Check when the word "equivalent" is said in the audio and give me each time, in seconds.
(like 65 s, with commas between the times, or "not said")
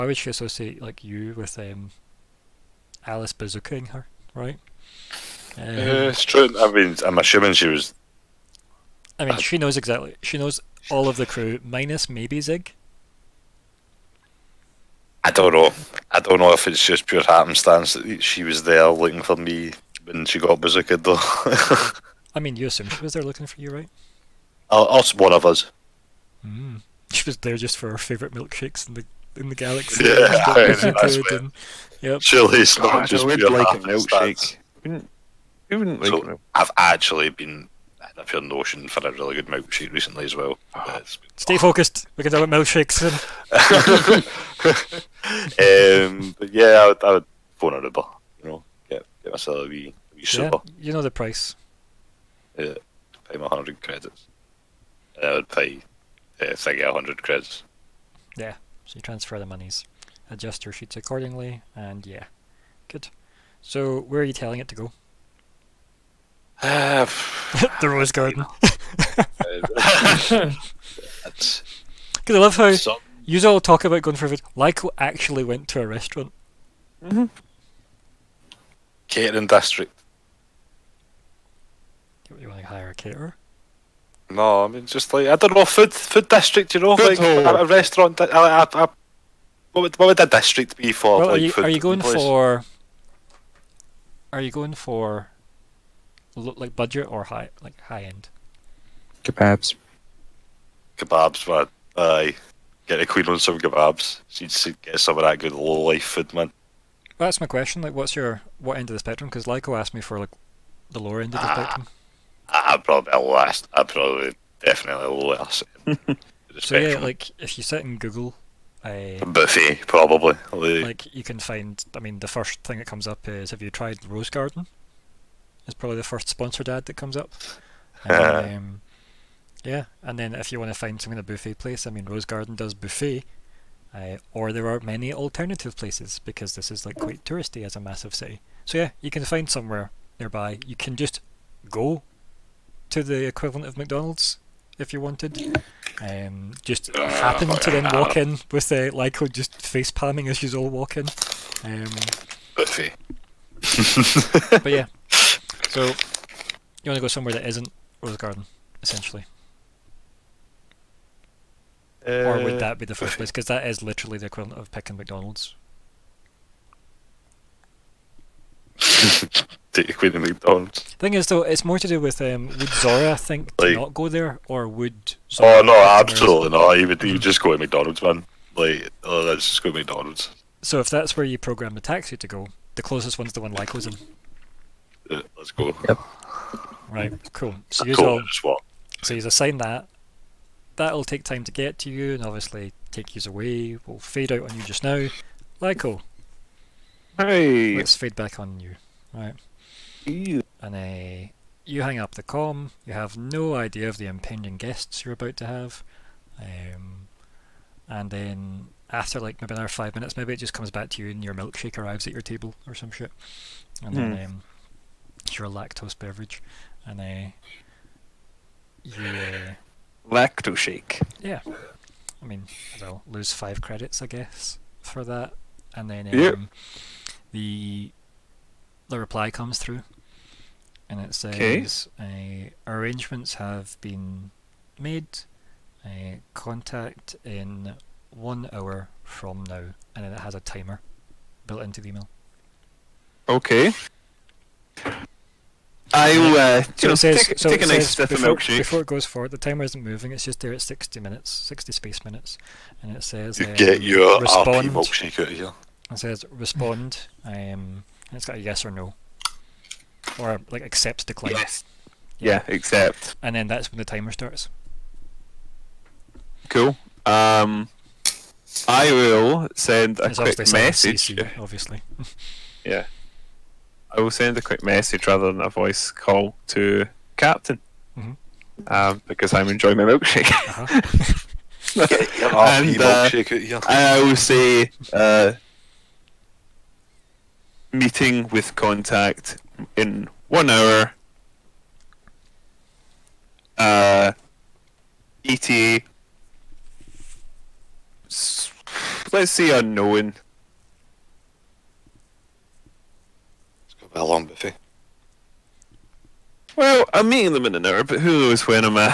143 s, 164 s.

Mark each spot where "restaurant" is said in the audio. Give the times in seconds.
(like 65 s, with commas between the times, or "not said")
75 s, 87 s.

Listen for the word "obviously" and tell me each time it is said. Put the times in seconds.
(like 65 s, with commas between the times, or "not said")
192 s, 271 s.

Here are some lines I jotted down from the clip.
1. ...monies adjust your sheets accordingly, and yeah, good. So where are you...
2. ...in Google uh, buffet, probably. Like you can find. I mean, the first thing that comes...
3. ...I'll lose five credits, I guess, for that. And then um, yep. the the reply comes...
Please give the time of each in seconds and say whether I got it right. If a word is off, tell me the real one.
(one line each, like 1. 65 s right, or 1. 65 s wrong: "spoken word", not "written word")
1. 59 s right
2. 117 s right
3. 222 s right.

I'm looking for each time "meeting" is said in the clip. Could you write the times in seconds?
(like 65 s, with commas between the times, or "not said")
287 s, 307 s.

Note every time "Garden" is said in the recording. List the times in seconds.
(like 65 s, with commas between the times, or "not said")
68 s, 124 s, 132 s, 158 s.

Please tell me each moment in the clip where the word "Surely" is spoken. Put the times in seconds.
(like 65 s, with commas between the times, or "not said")
32 s.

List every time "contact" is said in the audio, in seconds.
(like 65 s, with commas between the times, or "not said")
236 s, 288 s.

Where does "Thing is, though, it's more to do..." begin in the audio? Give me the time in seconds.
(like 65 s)
170 s.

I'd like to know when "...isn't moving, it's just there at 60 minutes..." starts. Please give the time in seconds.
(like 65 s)
249 s.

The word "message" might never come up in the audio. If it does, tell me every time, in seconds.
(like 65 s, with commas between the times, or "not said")
270 s, 274 s.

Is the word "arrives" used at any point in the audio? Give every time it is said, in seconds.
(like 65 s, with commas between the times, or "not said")
211 s.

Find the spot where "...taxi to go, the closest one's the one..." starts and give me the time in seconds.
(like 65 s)
181 s.